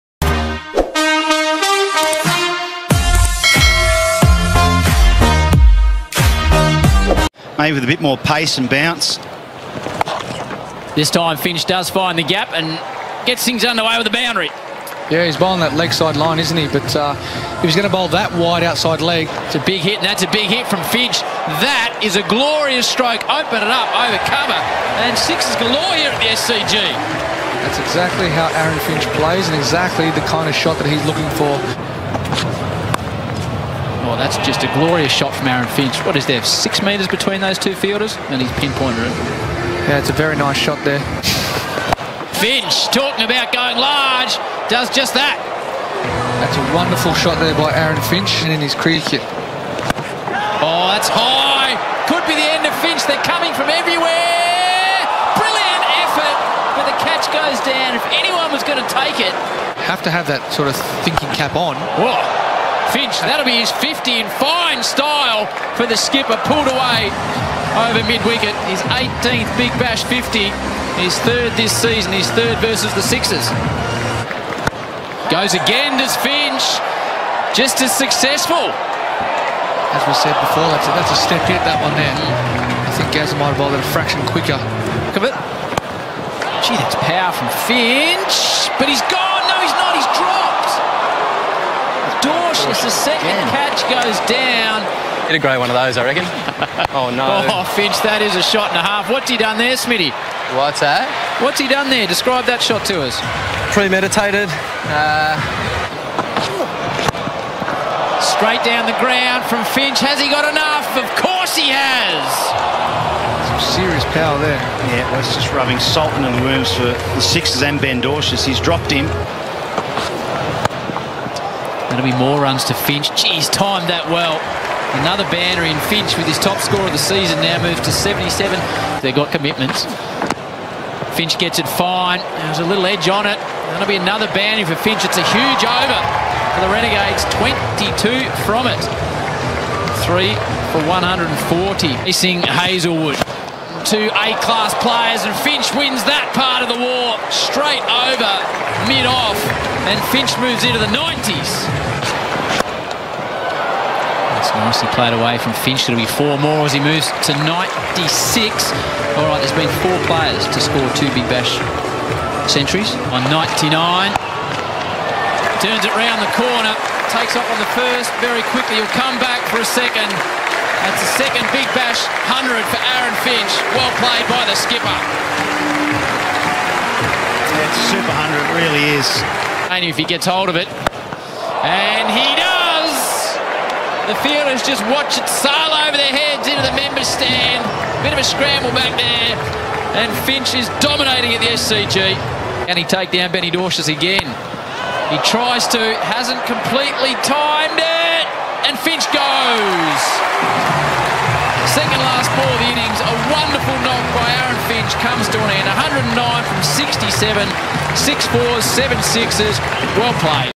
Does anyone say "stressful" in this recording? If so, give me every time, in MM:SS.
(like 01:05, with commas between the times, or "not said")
not said.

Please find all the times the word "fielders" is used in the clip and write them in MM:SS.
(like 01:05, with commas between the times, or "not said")
00:37, 03:04.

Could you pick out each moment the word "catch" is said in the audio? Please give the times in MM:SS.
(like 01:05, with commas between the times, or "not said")
00:56, 01:33.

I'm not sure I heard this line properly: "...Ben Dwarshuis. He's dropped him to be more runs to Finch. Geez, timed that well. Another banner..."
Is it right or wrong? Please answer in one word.
right.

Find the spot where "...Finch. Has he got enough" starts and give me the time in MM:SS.
01:49.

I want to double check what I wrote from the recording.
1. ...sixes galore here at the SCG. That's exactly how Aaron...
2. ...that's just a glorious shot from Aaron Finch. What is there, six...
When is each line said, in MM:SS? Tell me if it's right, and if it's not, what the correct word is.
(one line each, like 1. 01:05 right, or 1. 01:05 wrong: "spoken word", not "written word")
1. 00:25 right
2. 00:34 right.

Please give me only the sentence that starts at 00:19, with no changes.
It's a big hit, and that's a big hit from Finch.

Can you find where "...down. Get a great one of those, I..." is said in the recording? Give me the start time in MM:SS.
01:34.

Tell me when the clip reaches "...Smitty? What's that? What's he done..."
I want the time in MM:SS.
01:39.